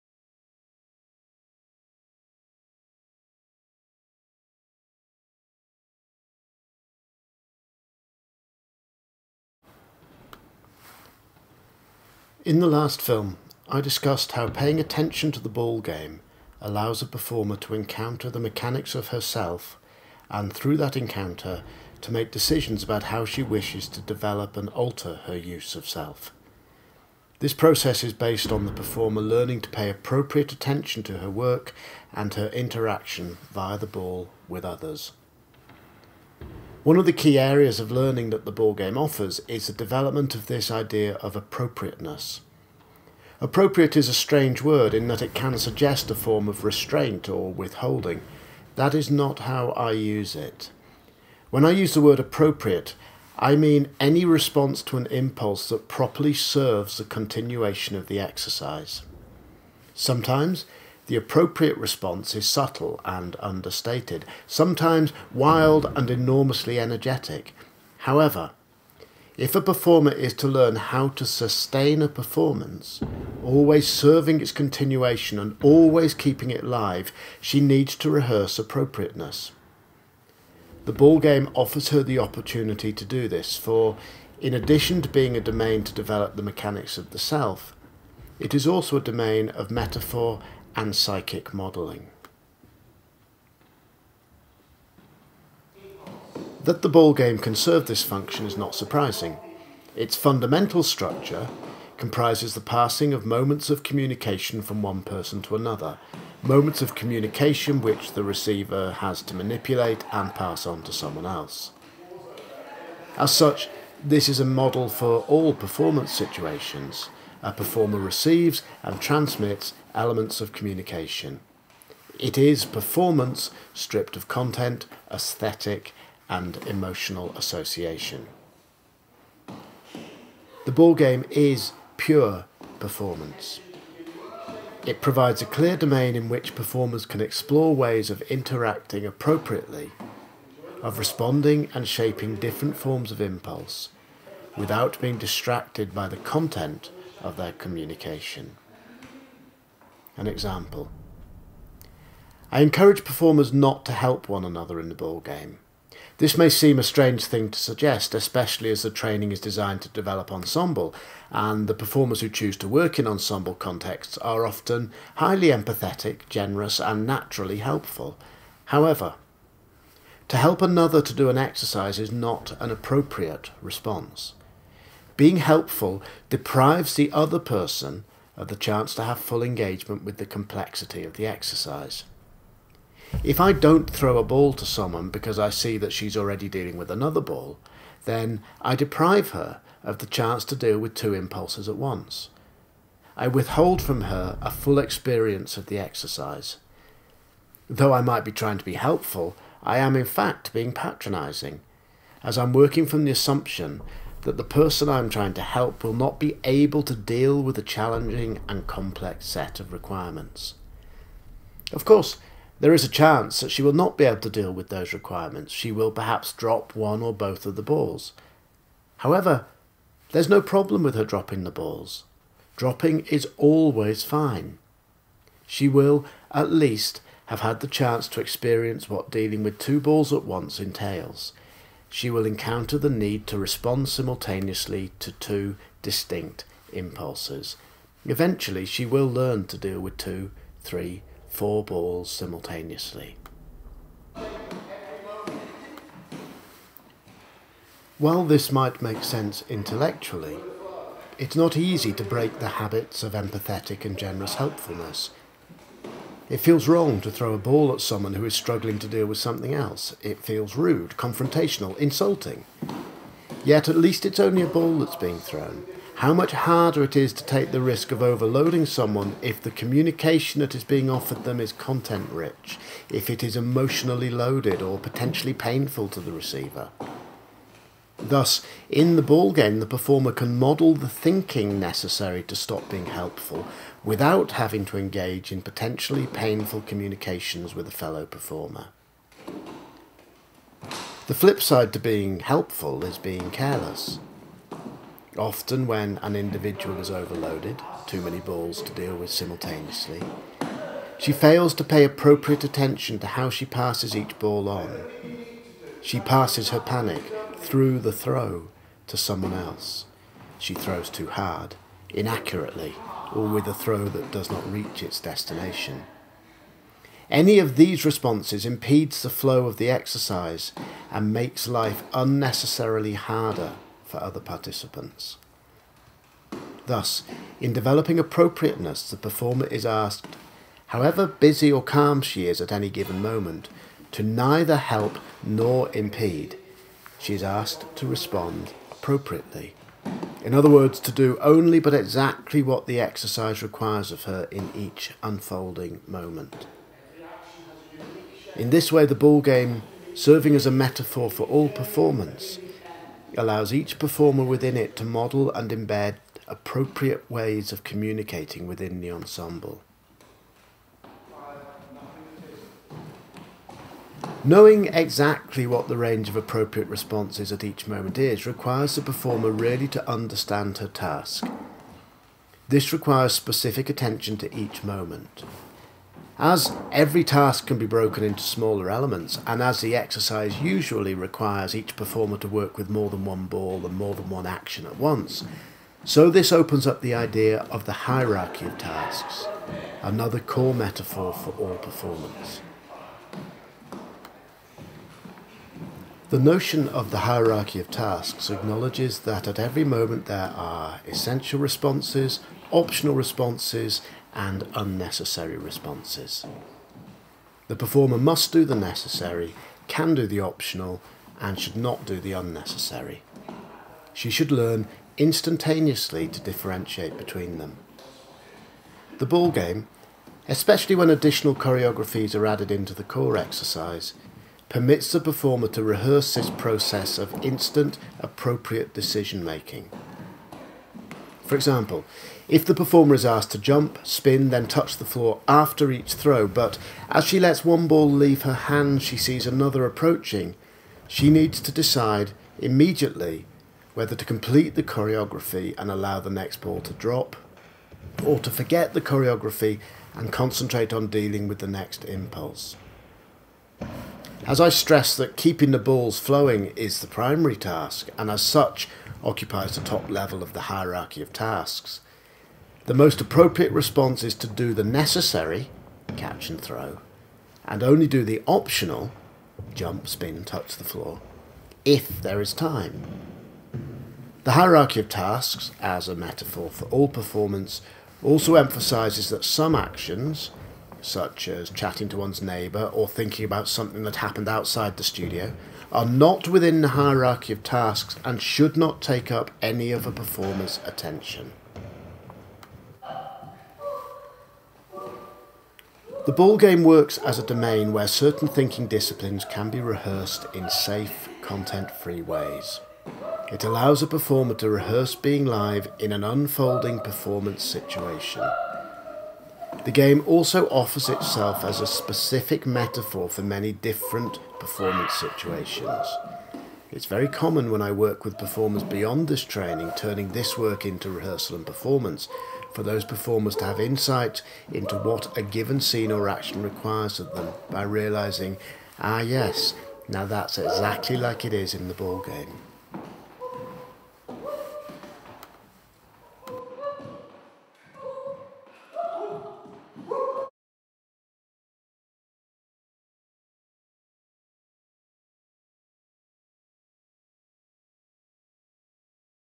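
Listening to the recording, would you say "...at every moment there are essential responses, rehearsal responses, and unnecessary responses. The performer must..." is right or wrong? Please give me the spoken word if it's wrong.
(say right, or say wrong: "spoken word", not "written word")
wrong: "optional", not "rehearsal".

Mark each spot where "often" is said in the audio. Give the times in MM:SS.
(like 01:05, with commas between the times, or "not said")
02:44, 04:55.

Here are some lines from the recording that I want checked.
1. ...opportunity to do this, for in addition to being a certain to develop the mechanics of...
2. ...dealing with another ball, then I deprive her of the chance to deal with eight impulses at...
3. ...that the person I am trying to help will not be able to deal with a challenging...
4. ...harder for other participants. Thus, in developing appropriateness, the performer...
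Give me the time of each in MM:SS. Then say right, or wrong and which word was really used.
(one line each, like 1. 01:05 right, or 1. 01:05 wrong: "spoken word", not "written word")
1. 01:22 wrong: "domain", not "certain"
2. 03:06 wrong: "two", not "eight"
3. 03:24 right
4. 05:22 right.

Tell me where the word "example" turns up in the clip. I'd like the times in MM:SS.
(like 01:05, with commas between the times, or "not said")
02:30, 07:11.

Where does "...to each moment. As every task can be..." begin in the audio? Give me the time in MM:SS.
06:14.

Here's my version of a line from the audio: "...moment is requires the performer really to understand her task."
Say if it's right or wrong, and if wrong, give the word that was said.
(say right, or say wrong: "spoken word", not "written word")
right.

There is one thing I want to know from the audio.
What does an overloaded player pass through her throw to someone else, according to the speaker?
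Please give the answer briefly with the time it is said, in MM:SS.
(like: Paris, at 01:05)
Her panic, at 05:06.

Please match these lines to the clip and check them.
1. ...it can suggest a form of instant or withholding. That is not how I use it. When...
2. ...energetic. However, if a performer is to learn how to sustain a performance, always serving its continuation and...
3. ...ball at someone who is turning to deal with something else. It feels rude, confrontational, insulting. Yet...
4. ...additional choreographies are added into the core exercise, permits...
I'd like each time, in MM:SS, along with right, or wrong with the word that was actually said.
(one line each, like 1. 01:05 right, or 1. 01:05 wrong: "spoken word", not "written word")
1. 00:45 wrong: "restraint", not "instant"
2. 01:06 right
3. 04:17 wrong: "struggling", not "turning"
4. 07:00 right.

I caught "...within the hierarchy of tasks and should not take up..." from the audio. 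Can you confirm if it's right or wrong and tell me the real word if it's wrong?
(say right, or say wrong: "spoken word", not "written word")
right.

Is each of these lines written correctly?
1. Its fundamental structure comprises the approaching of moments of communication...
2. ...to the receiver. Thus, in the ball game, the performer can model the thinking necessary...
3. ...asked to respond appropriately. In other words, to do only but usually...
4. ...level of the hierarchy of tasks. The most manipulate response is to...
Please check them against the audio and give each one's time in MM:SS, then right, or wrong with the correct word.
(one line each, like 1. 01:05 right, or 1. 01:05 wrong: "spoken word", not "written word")
1. 01:39 wrong: "passing", not "approaching"
2. 04:35 right
3. 05:37 wrong: "exactly", not "usually"
4. 07:39 wrong: "appropriate", not "manipulate".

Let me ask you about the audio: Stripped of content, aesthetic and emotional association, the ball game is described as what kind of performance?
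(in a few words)
Pure performance.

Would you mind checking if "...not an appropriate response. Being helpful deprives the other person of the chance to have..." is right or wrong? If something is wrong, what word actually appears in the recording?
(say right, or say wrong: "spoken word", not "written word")
right.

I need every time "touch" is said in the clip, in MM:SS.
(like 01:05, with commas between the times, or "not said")
07:14, 07:50.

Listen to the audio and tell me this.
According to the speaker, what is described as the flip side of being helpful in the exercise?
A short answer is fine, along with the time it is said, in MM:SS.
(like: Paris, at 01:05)
Being careless, at 04:52.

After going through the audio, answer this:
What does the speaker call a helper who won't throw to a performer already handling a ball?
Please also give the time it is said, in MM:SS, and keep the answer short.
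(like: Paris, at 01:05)
Patronising, at 03:20.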